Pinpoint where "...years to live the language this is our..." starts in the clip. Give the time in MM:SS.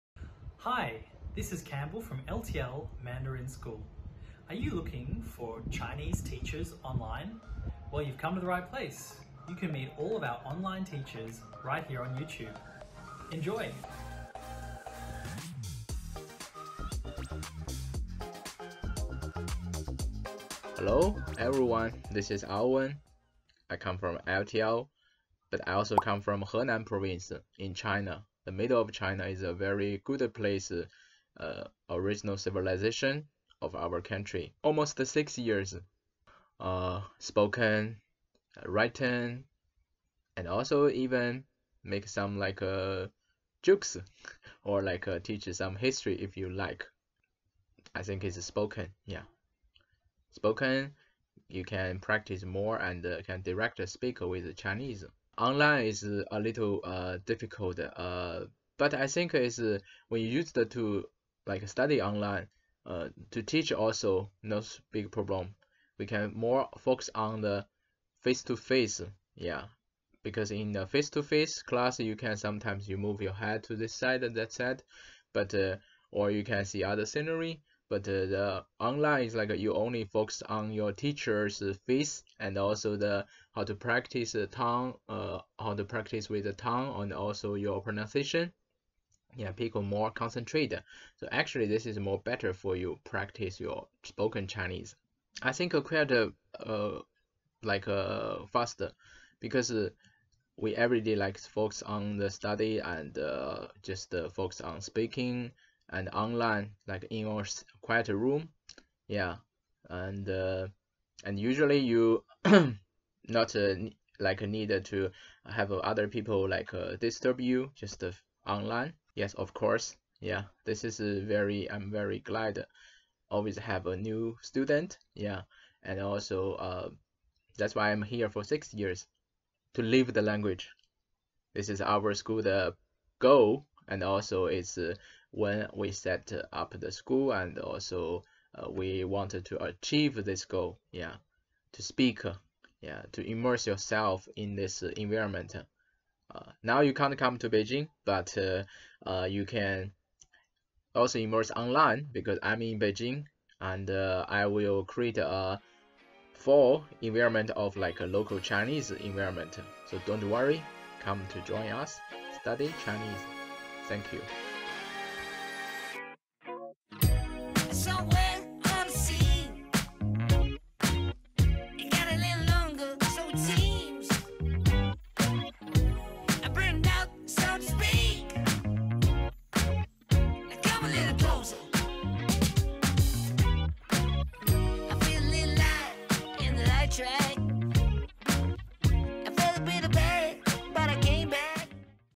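02:08.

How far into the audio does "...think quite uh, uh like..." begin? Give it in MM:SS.
01:35.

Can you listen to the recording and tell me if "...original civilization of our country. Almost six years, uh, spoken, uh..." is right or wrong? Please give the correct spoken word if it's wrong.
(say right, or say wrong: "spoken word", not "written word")
right.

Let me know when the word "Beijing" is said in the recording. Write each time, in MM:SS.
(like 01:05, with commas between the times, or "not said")
02:27, 02:32.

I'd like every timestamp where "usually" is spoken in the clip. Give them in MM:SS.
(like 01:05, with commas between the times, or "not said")
01:51.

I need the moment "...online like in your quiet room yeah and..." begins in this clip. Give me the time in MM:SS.
01:46.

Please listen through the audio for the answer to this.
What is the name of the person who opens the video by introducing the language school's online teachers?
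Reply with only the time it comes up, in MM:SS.
00:01.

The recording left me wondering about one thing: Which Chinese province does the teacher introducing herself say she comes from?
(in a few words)
Henan.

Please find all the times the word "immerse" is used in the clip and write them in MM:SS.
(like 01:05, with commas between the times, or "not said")
02:23, 02:31.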